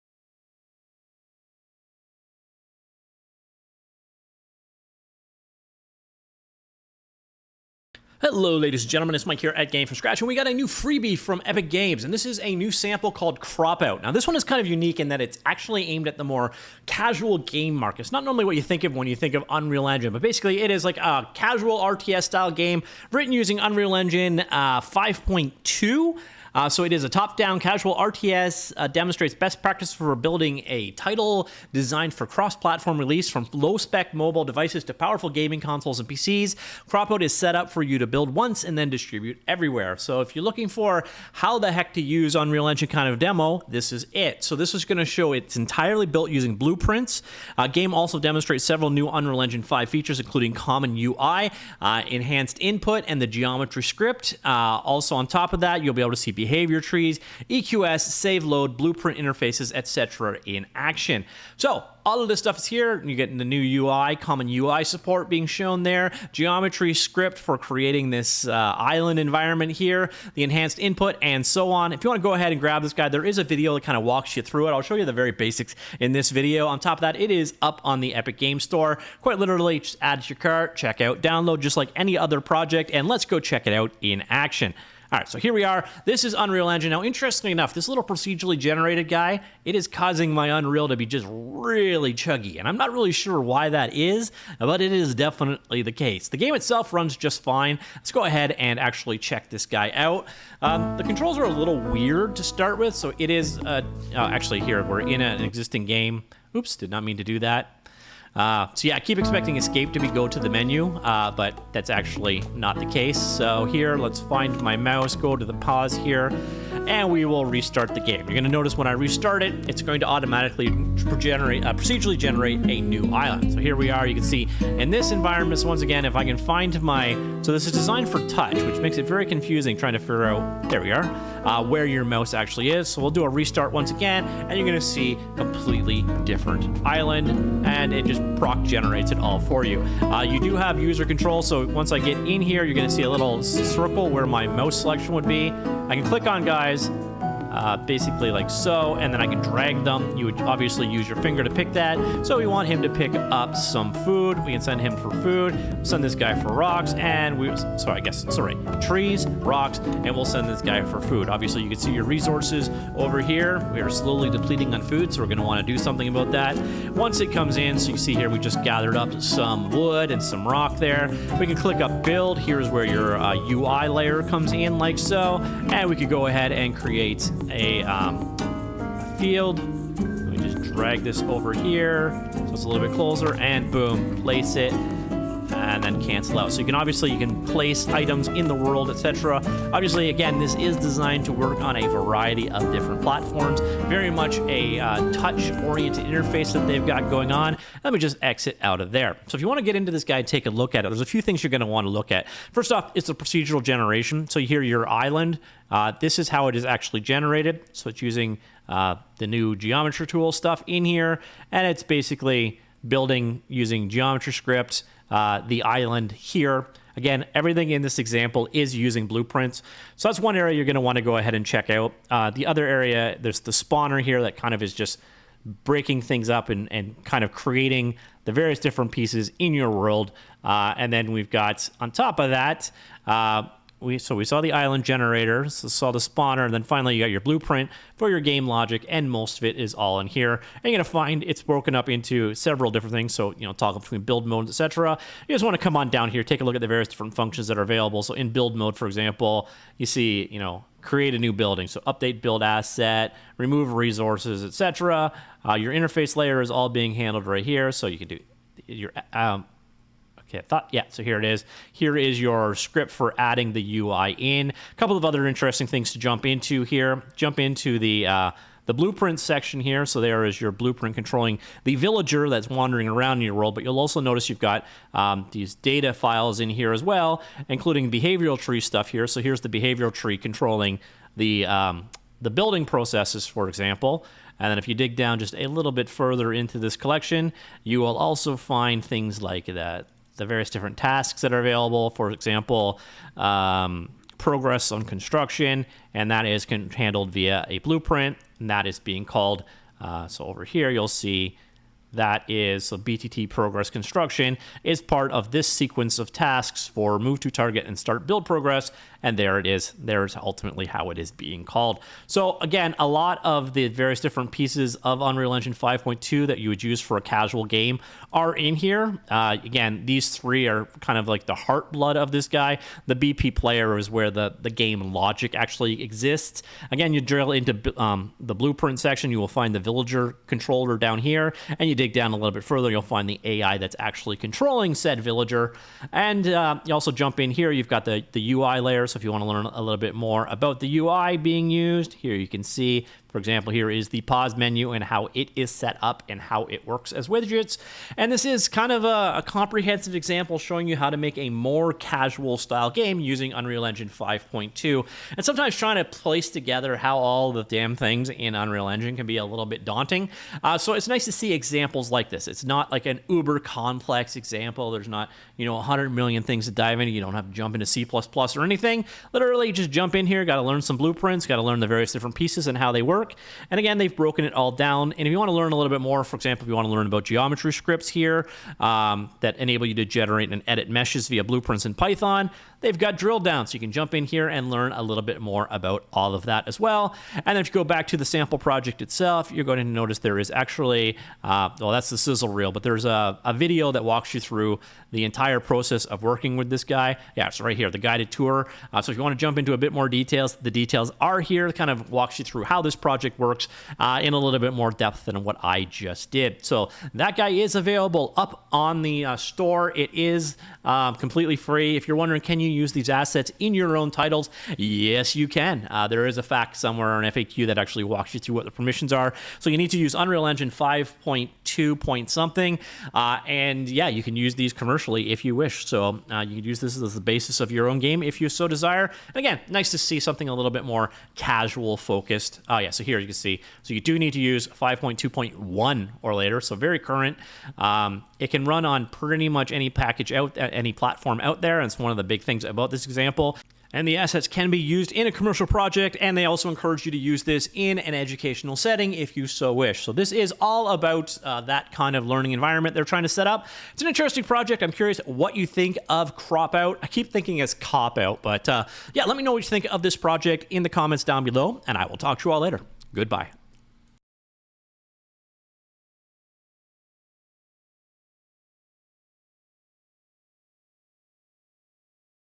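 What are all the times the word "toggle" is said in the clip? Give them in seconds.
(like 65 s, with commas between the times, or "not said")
243 s.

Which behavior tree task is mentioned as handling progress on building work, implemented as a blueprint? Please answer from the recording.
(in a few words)
BTT progress construction.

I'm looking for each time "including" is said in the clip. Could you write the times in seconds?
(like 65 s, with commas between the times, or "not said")
50 s, 277 s.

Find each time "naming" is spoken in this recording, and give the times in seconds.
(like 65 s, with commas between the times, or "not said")
not said.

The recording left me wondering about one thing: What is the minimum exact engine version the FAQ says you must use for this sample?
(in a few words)
5.2.1.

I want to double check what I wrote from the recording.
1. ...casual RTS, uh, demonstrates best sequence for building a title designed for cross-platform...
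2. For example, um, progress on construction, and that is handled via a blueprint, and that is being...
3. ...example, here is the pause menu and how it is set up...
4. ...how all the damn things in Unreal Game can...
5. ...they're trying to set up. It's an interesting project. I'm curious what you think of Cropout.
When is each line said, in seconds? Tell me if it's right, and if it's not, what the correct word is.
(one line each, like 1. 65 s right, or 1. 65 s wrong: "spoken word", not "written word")
1. 27 s wrong: "practice", not "sequence"
2. 291 s right
3. 343 s right
4. 356 s wrong: "Engine", not "Game"
5. 452 s right.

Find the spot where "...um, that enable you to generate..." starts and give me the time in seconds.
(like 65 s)
378 s.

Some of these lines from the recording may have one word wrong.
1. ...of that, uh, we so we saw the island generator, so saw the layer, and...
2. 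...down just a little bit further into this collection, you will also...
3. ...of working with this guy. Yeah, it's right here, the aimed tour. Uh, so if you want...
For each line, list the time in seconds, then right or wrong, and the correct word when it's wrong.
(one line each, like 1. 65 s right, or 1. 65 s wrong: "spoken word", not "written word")
1. 232 s wrong: "spawner", not "layer"
2. 284 s right
3. 395 s wrong: "guided", not "aimed".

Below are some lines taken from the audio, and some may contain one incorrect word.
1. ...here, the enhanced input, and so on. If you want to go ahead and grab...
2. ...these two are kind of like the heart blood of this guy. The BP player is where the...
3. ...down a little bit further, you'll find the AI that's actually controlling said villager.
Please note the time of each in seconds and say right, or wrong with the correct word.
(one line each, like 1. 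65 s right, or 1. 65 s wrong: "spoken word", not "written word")
1. 69 s right
2. 319 s wrong: "three", not "two"
3. 331 s right.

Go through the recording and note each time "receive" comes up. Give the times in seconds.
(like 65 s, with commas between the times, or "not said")
not said.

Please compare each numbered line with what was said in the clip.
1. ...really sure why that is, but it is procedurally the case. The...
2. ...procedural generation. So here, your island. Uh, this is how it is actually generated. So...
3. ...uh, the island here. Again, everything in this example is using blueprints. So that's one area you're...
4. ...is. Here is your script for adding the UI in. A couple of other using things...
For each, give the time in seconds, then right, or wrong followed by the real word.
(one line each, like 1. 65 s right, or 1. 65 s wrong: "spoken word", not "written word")
1. 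92 s wrong: "definitely", not "procedurally"
2. 203 s right
3. 215 s right
4. 261 s wrong: "interesting", not "using".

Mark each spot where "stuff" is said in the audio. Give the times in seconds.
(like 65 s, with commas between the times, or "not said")
62 s, 210 s, 278 s.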